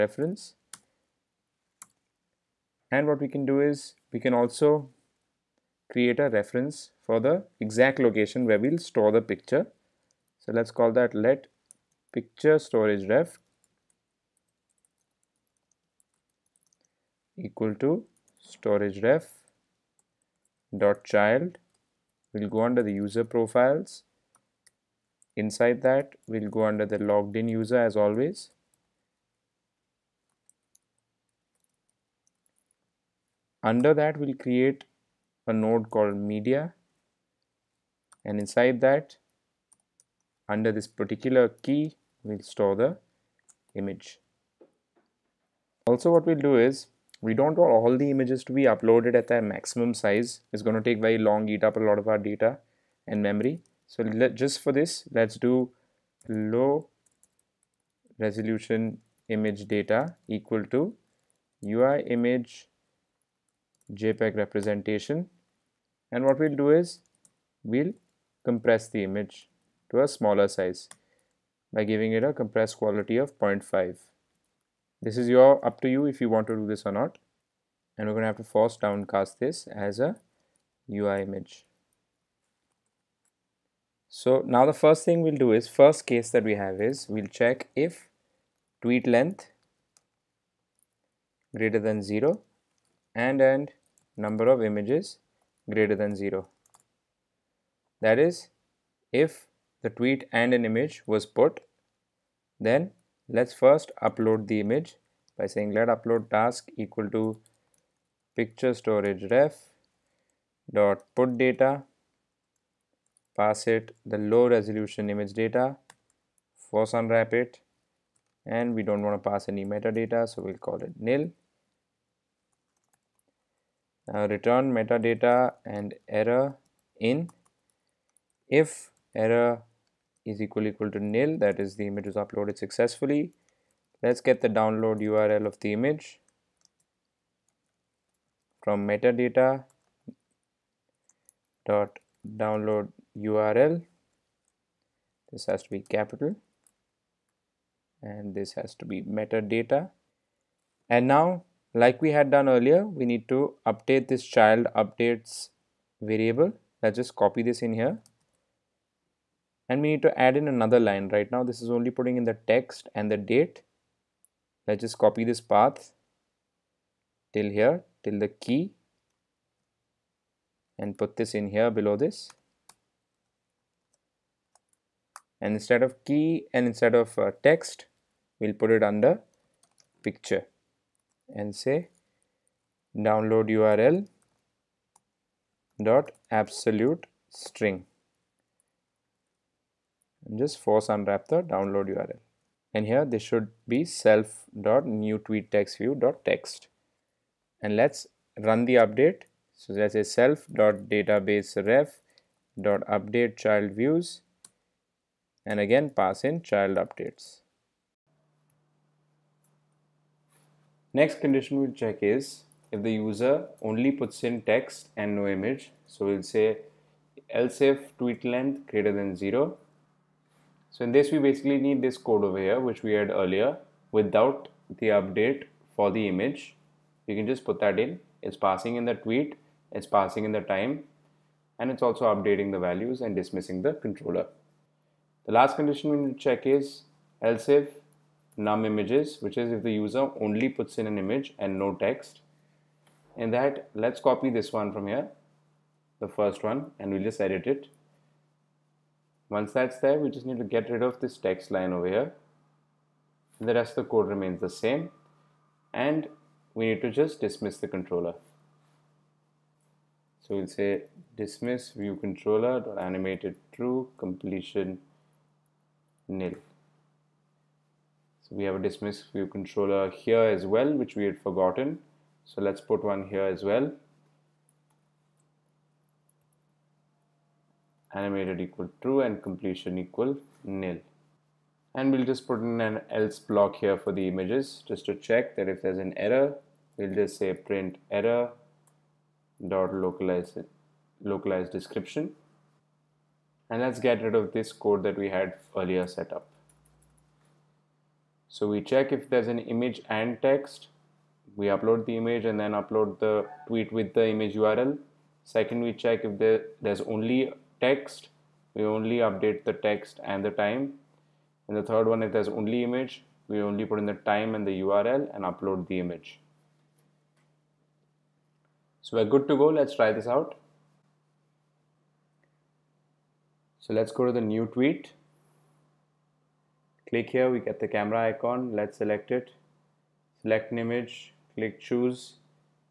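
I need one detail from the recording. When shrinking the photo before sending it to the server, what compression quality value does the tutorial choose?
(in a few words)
0.5.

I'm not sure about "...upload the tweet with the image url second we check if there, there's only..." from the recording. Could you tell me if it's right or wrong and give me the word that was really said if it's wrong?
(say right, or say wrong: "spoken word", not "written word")
right.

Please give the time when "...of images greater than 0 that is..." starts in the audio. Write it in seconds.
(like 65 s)
94 s.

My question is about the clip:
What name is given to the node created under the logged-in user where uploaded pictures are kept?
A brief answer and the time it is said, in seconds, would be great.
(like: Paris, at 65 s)
media, at 36 s.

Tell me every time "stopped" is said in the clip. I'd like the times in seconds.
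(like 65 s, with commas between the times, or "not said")
not said.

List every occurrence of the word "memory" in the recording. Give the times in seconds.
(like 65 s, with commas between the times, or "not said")
53 s.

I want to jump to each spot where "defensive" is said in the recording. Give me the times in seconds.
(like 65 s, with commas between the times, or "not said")
not said.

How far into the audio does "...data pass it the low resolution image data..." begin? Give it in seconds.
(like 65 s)
111 s.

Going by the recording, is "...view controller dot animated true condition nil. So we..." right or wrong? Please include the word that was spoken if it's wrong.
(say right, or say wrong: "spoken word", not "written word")
wrong: "completion", not "condition".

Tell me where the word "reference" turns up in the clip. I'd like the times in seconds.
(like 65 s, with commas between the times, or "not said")
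6 s.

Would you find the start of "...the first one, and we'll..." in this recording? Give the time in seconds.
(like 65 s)
246 s.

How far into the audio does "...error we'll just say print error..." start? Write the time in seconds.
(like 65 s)
286 s.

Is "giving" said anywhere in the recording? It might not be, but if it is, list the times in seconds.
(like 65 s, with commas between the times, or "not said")
71 s.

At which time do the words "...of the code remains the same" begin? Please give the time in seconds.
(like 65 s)
253 s.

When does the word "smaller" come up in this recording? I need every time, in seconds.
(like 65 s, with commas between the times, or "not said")
70 s.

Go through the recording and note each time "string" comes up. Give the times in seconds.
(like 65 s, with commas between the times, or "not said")
187 s.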